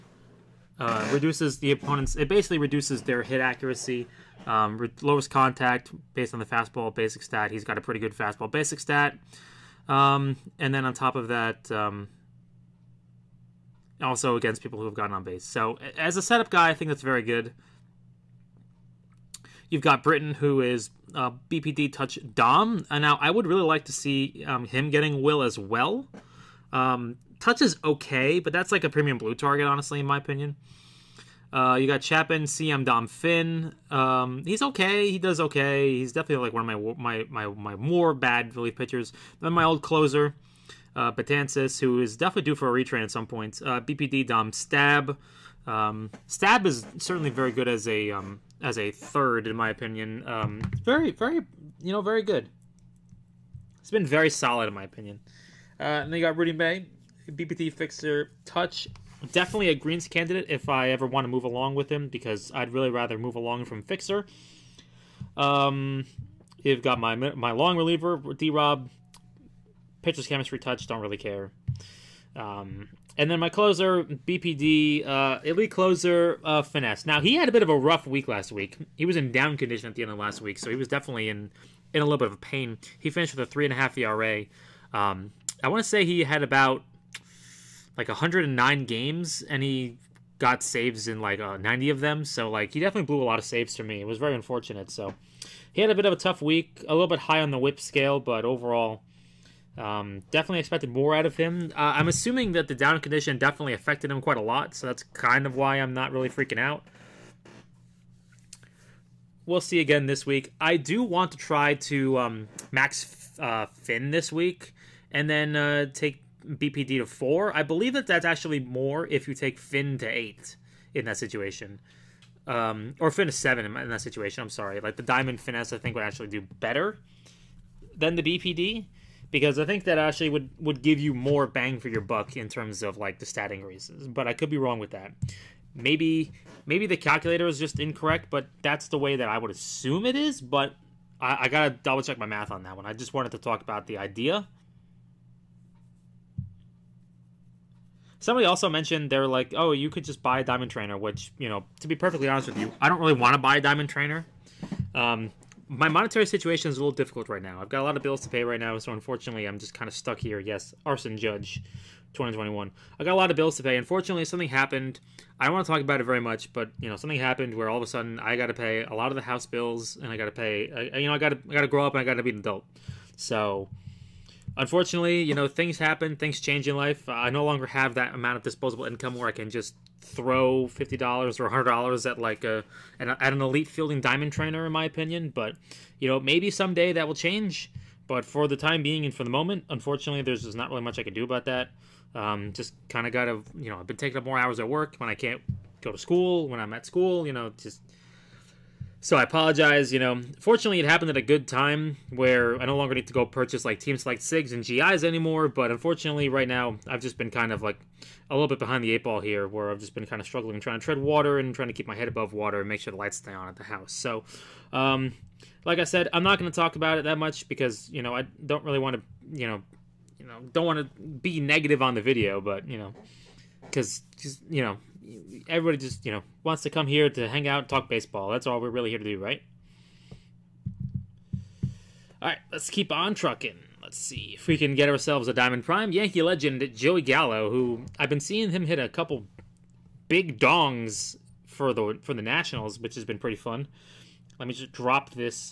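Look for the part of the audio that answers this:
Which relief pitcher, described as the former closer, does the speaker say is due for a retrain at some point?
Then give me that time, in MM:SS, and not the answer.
00:41.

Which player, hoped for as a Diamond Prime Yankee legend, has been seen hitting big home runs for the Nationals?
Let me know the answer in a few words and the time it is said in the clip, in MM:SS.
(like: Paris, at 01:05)
Joey Gallo, at 03:56.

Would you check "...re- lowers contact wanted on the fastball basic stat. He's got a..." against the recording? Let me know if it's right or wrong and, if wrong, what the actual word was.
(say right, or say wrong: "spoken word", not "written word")
wrong: "based", not "wanted".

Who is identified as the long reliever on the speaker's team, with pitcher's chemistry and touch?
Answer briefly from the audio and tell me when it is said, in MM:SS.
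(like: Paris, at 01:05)
D Rob, at 01:08.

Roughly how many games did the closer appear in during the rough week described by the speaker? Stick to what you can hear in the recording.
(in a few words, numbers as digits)
109.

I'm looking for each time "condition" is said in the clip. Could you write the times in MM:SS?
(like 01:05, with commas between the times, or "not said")
01:19, 01:42.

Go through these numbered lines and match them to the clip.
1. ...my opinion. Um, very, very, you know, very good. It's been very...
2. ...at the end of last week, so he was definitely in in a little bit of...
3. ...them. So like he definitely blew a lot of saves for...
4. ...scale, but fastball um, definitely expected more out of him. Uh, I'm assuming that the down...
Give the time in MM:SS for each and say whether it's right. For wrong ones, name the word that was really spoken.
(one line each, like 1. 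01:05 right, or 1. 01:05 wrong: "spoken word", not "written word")
1. 00:49 right
2. 01:19 right
3. 01:32 right
4. 01:37 wrong: "overall", not "fastball".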